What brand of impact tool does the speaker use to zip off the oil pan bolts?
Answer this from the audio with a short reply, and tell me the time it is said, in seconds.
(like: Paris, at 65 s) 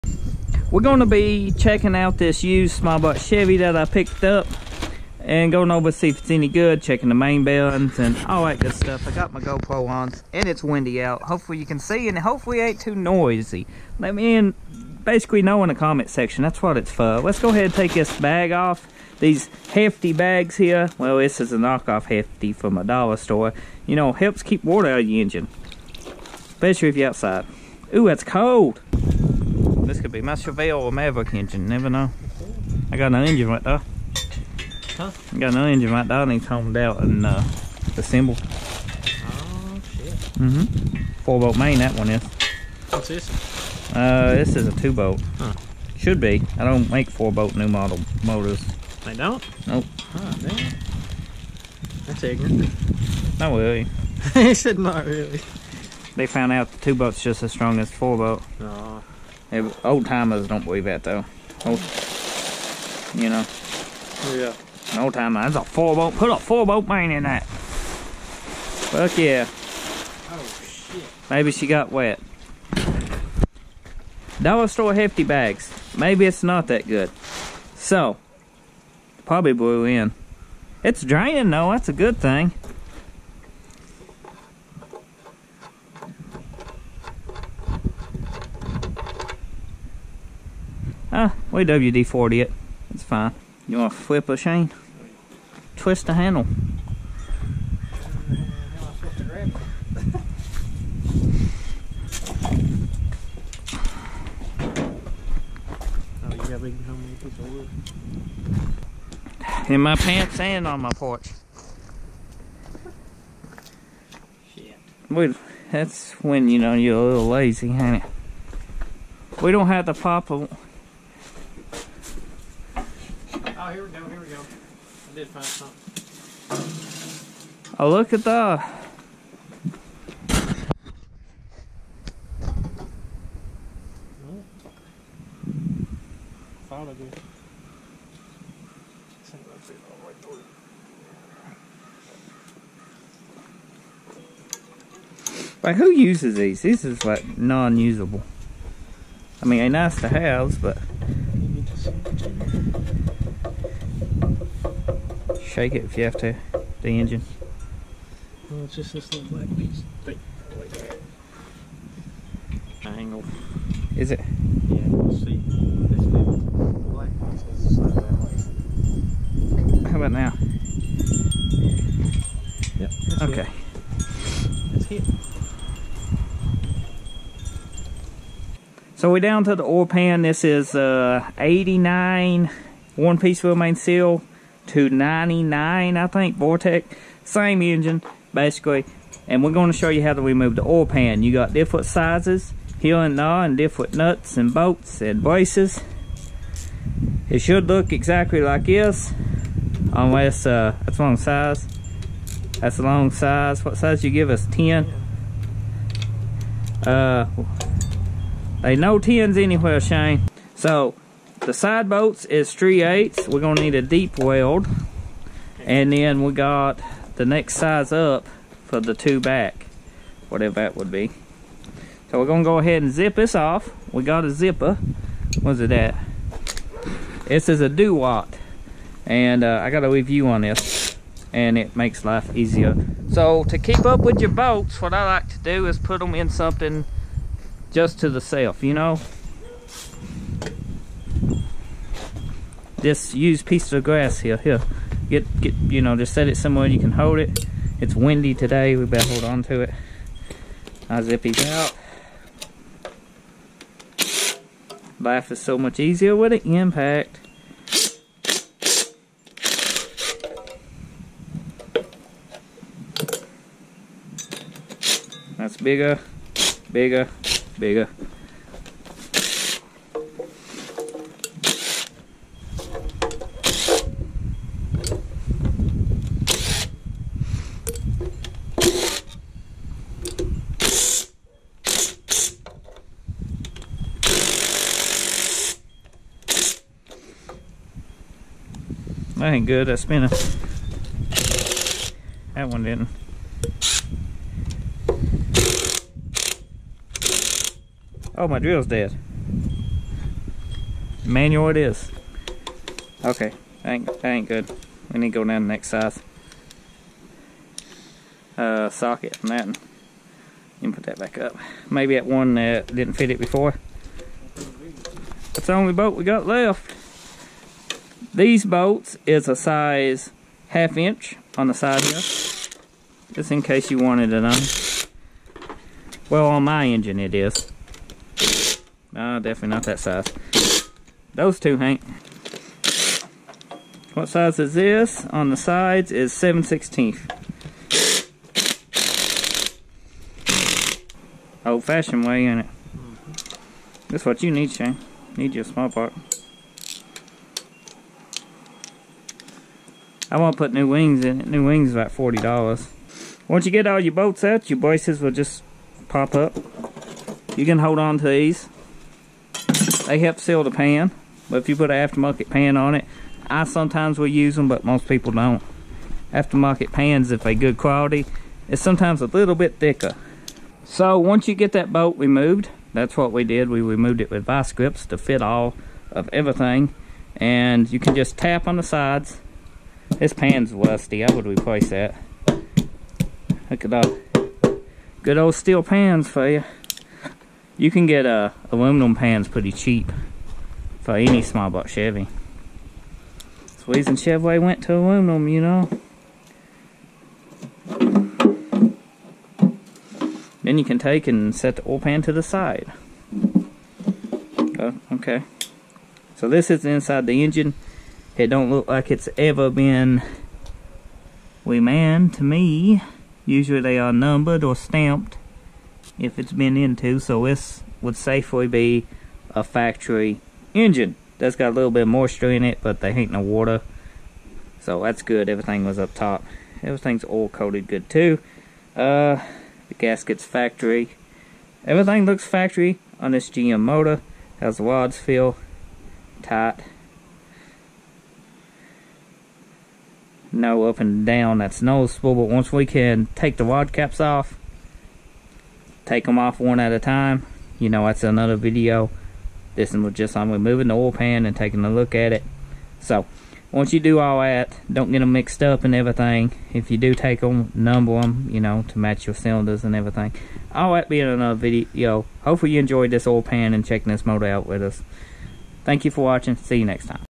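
DeWalt, at 227 s.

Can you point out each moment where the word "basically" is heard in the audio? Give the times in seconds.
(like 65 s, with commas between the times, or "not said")
15 s, 188 s.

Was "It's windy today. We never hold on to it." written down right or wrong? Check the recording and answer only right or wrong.
wrong.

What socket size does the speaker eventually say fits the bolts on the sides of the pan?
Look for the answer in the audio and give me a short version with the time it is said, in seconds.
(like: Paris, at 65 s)
7/16, at 336 s.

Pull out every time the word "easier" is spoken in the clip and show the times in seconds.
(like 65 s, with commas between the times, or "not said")
232 s, 255 s.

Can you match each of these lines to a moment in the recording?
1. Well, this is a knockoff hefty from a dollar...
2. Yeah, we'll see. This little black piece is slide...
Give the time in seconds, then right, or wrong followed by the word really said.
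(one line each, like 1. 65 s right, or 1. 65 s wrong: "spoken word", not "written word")
1. 20 s right
2. 164 s right.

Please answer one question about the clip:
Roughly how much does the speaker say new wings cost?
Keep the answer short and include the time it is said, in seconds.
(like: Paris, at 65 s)
$40, at 351 s.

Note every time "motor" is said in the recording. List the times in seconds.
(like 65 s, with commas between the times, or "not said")
48 s, 433 s, 464 s.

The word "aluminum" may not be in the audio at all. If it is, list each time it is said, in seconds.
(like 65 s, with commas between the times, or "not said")
388 s, 394 s.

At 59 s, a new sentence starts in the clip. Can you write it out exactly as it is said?
Old timers don't believe that though.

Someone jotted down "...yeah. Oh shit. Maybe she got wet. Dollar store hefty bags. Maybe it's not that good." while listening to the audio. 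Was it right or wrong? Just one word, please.
right.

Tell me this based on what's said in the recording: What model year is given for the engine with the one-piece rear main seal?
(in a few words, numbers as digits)
1989.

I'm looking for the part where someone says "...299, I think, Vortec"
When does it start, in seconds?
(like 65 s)
184 s.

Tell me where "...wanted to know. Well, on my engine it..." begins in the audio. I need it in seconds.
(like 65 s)
323 s.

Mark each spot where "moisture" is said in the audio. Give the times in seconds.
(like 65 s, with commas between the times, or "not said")
421 s.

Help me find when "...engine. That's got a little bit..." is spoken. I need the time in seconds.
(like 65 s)
420 s.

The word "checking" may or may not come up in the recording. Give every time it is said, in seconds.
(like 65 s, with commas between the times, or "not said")
1 s, 6 s, 463 s.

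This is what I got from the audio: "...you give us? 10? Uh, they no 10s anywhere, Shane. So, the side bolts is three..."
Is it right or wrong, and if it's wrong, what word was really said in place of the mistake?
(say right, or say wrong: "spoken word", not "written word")
right.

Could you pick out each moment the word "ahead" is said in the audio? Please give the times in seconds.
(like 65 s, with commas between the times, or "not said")
17 s, 222 s.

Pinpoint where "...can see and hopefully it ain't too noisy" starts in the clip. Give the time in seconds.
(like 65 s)
11 s.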